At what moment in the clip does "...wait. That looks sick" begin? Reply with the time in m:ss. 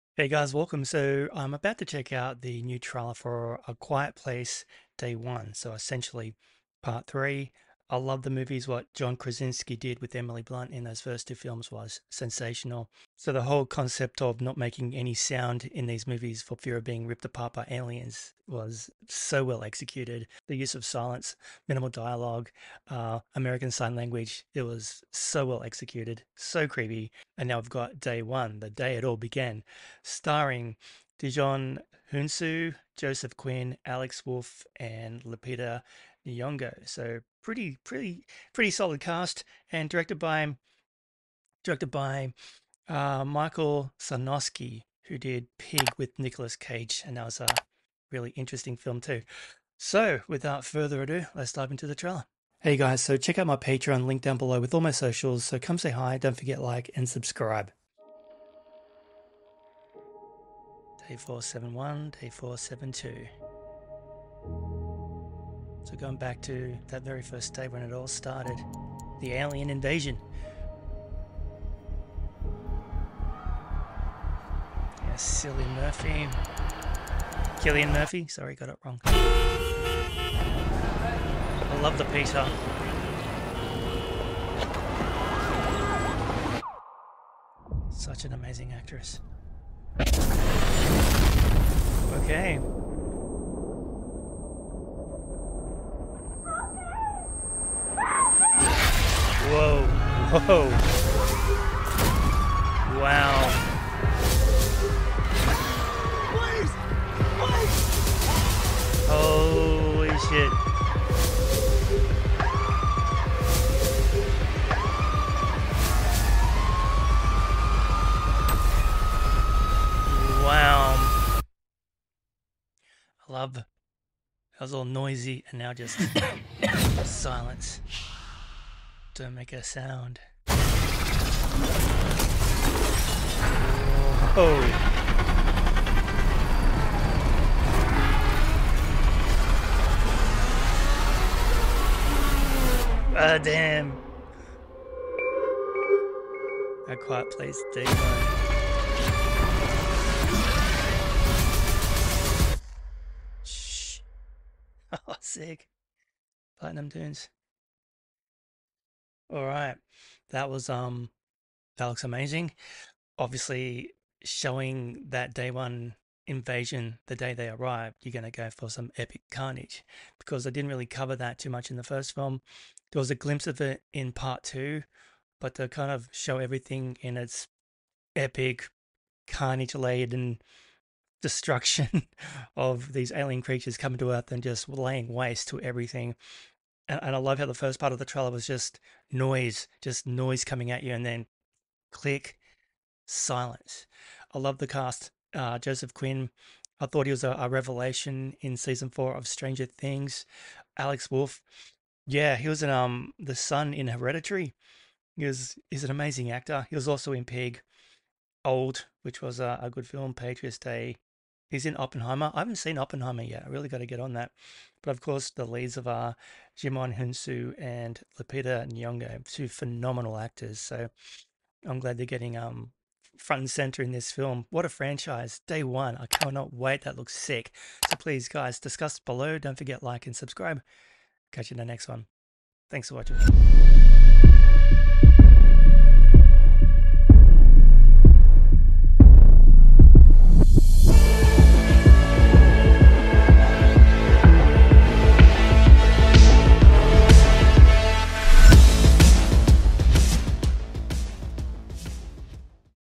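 3:46.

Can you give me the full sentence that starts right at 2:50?
Because I didn't really cover that too much in the first film.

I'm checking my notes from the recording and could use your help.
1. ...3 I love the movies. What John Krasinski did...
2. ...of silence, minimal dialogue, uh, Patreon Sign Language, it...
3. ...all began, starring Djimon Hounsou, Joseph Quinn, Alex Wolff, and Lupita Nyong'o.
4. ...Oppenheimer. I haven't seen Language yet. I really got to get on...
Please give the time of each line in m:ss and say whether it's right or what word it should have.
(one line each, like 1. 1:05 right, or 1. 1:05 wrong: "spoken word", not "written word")
1. 0:07 right
2. 0:20 wrong: "American", not "Patreon"
3. 0:29 right
4. 3:31 wrong: "Oppenheimer", not "Language".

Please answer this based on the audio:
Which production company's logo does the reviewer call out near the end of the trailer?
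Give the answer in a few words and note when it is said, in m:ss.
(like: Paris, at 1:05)
Platinum Dunes, at 2:36.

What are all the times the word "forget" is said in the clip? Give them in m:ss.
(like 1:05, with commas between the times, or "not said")
0:56, 3:49.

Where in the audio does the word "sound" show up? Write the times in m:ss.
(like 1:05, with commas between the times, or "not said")
0:15, 2:09.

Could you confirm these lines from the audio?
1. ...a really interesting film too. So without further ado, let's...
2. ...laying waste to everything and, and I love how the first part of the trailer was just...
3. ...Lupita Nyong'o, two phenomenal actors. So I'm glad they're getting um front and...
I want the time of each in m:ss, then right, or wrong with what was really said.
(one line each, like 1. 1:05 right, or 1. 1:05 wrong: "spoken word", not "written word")
1. 0:47 right
2. 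3:04 right
3. 3:38 right.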